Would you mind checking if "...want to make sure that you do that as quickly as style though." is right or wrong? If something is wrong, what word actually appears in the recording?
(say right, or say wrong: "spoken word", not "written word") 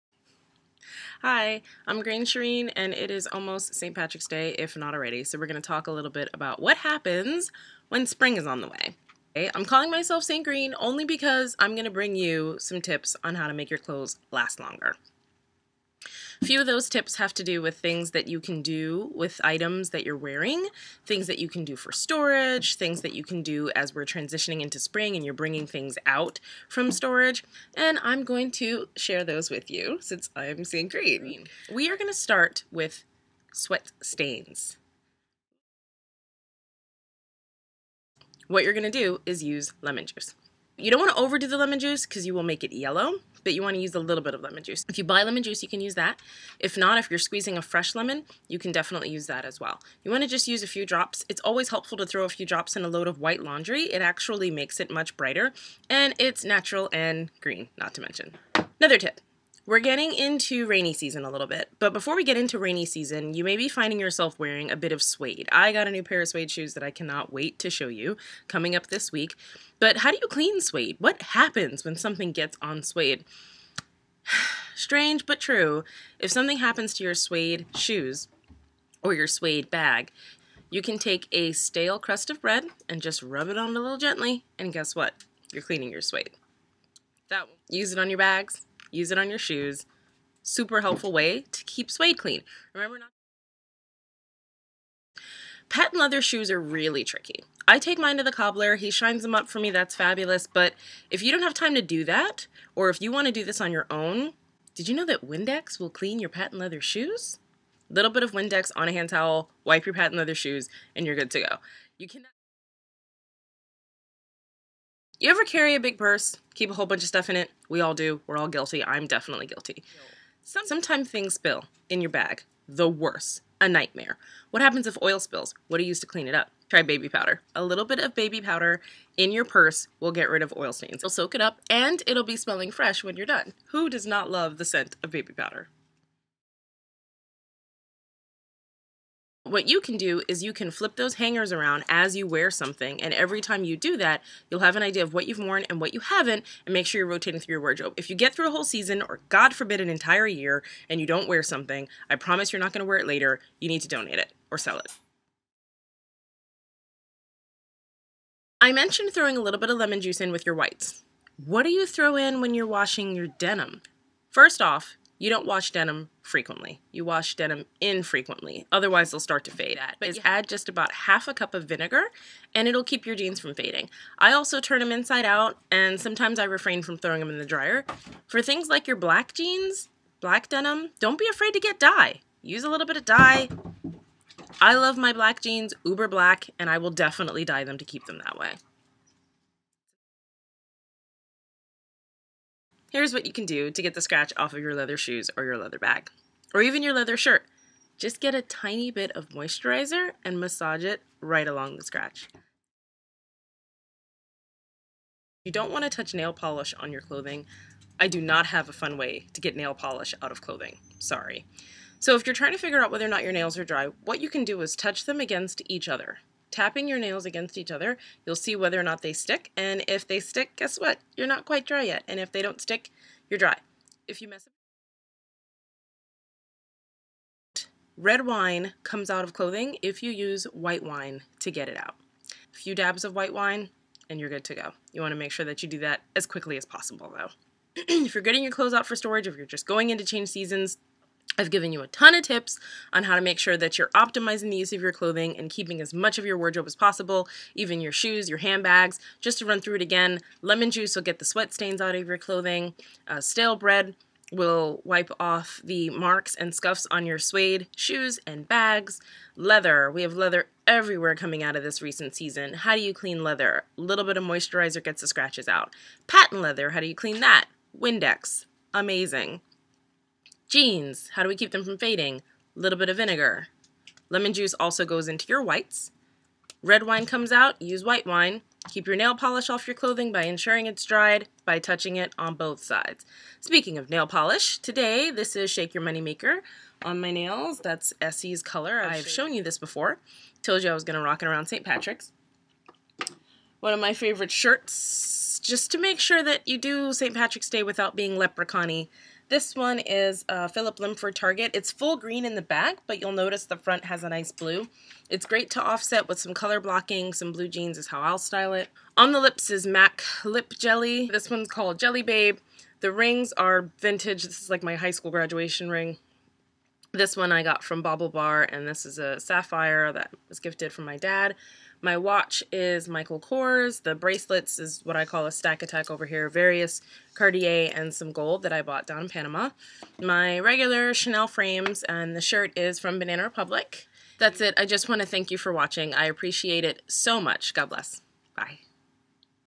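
wrong: "possible", not "style".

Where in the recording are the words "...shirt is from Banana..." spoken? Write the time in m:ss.
5:32.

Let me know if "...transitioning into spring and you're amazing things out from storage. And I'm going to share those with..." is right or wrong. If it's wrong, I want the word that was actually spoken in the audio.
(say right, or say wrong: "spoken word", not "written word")
wrong: "bringing", not "amazing".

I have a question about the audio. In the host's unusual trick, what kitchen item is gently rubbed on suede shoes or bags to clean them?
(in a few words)
Stale crust of bread.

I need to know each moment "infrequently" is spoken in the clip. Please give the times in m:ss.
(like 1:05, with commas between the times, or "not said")
2:47.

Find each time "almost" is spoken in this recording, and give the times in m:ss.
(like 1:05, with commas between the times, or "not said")
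0:03.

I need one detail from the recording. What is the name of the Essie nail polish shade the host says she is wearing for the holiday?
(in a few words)
Shake Your Money Maker.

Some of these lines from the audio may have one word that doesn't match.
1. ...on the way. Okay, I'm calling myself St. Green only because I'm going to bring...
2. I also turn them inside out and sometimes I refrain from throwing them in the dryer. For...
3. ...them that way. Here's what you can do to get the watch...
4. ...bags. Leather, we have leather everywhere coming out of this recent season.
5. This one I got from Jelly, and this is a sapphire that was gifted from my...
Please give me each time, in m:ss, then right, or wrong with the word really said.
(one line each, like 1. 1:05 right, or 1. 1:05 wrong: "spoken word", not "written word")
1. 0:08 right
2. 2:54 right
3. 3:08 wrong: "scratch", not "watch"
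4. 4:18 right
5. 5:16 wrong: "BaubleBar", not "Jelly".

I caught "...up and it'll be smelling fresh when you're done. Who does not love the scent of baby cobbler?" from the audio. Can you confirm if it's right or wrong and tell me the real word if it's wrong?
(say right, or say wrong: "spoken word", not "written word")
wrong: "powder", not "cobbler".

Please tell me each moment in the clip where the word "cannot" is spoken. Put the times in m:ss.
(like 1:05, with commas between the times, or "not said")
1:06, 1:52.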